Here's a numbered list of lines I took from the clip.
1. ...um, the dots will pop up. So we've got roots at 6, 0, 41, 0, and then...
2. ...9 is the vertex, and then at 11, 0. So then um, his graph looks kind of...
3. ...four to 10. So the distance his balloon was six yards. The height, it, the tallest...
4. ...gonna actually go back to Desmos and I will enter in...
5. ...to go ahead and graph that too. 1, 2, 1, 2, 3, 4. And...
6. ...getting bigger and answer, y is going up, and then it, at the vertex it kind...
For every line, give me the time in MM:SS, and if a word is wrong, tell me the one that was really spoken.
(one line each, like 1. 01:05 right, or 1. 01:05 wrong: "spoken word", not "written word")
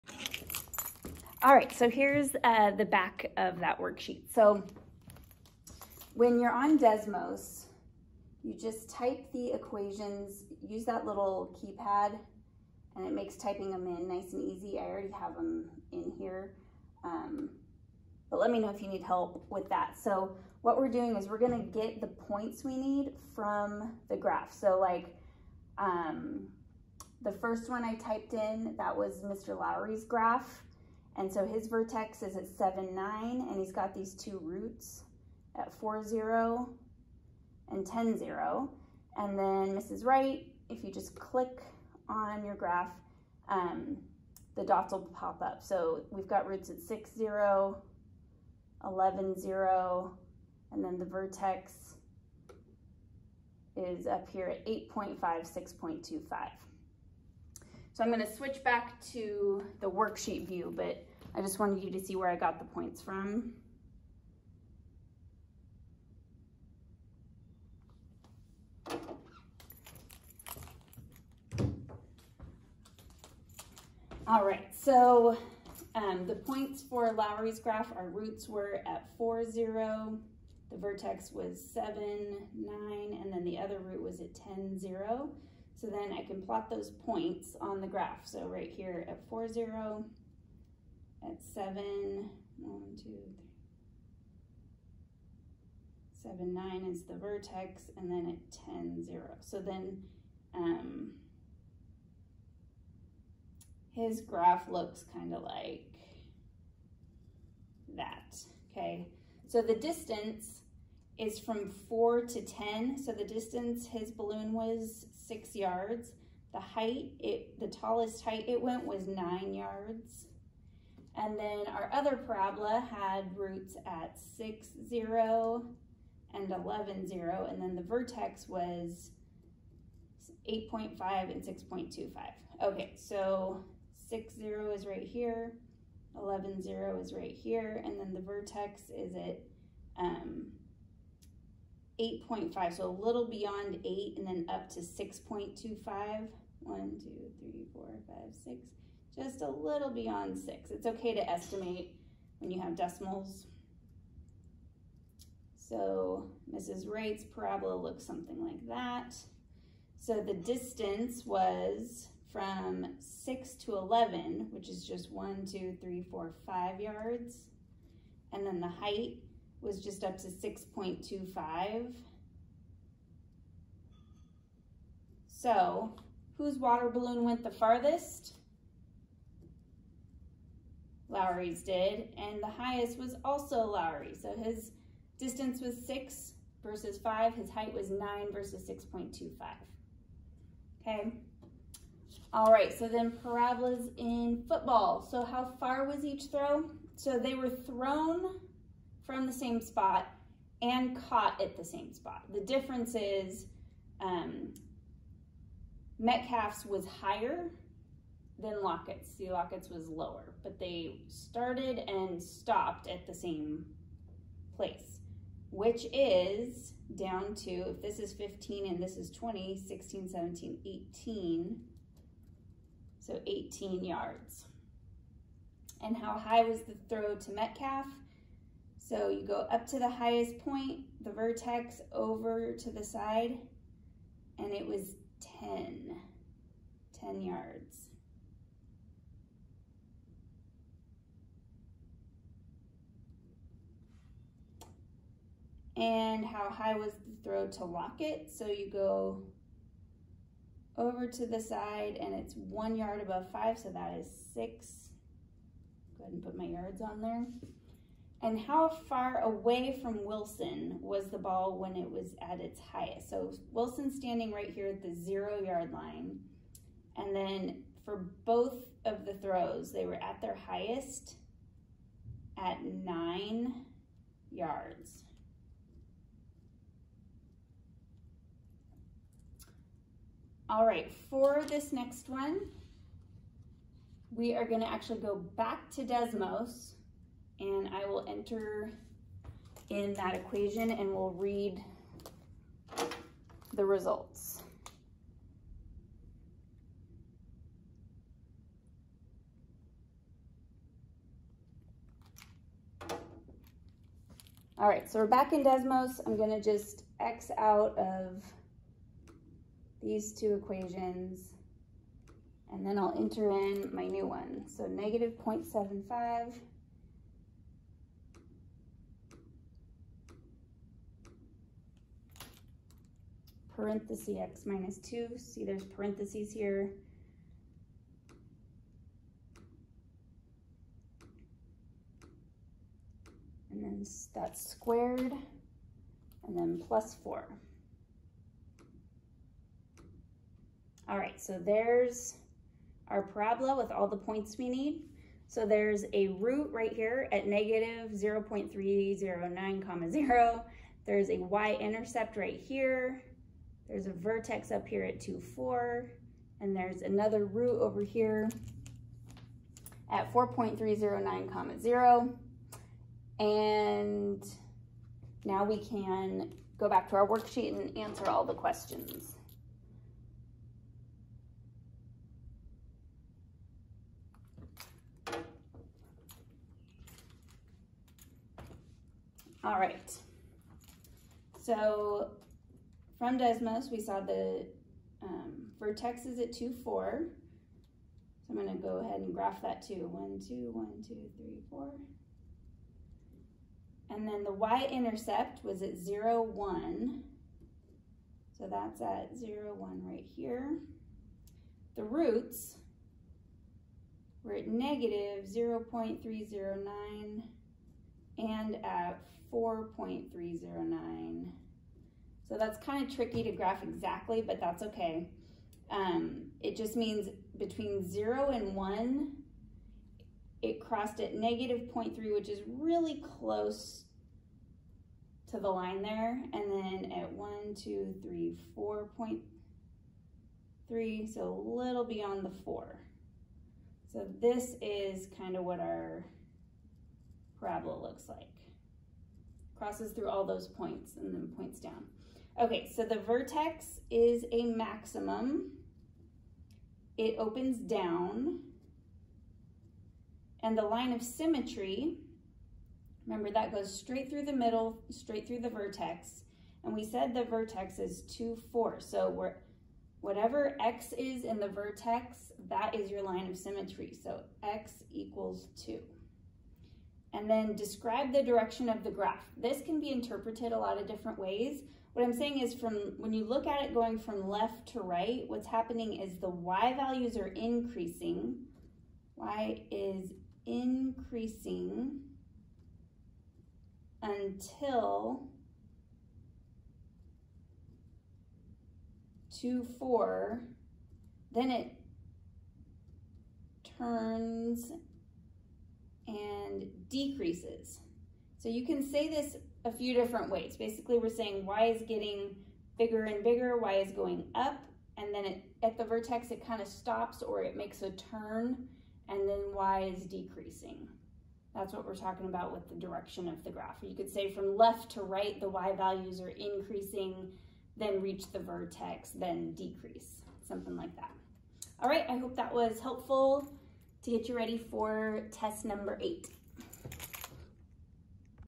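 1. 00:43 wrong: "11", not "41"
2. 01:36 wrong: "10", not "11"
3. 01:51 right
4. 04:44 right
5. 06:28 right
6. 08:21 wrong: "bigger", not "answer".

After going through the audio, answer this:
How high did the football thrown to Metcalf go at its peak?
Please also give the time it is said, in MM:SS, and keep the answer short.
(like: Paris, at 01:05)
10 yards, at 03:55.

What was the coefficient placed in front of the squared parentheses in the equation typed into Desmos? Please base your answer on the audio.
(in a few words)
-0.75.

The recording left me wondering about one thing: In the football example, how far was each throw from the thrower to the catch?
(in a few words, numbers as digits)
18 yards.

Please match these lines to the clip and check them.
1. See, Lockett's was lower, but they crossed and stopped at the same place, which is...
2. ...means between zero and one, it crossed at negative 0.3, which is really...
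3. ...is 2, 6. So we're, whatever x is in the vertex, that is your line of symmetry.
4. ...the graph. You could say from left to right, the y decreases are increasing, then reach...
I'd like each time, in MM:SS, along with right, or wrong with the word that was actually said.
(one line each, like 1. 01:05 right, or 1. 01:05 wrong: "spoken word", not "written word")
1. 03:29 wrong: "started", not "crossed"
2. 06:56 right
3. 07:37 wrong: "4", not "6"
4. 08:33 wrong: "values", not "decreases".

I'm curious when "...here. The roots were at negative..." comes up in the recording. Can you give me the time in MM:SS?
06:40.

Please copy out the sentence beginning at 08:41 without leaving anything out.
All right, I hope that was helpful to get you ready for test number eight.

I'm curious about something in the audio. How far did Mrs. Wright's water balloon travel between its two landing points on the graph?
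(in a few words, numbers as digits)
5 yards.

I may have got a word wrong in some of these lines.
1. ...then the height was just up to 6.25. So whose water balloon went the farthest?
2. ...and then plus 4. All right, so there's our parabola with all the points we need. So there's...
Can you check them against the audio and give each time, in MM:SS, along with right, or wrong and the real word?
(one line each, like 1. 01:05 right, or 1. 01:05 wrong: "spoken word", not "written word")
1. 02:48 right
2. 05:36 right.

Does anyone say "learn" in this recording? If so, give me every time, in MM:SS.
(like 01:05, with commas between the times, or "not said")
not said.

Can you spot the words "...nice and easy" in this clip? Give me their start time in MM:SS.
00:14.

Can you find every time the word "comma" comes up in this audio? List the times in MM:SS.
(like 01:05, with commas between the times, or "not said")
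05:49, 06:01.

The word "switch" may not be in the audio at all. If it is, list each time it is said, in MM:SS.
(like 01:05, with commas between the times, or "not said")
00:58.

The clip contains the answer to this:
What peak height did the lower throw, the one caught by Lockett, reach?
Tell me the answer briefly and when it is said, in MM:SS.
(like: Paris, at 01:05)
6 yards, at 04:13.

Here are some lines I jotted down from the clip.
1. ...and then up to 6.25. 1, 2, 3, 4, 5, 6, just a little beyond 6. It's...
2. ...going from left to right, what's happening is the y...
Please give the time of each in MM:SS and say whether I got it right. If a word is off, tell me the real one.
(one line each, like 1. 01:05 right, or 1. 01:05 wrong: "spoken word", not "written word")
1. 02:24 right
2. 07:53 right.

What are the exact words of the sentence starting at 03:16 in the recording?
So they were thrown from the same spot and caught at the same spot.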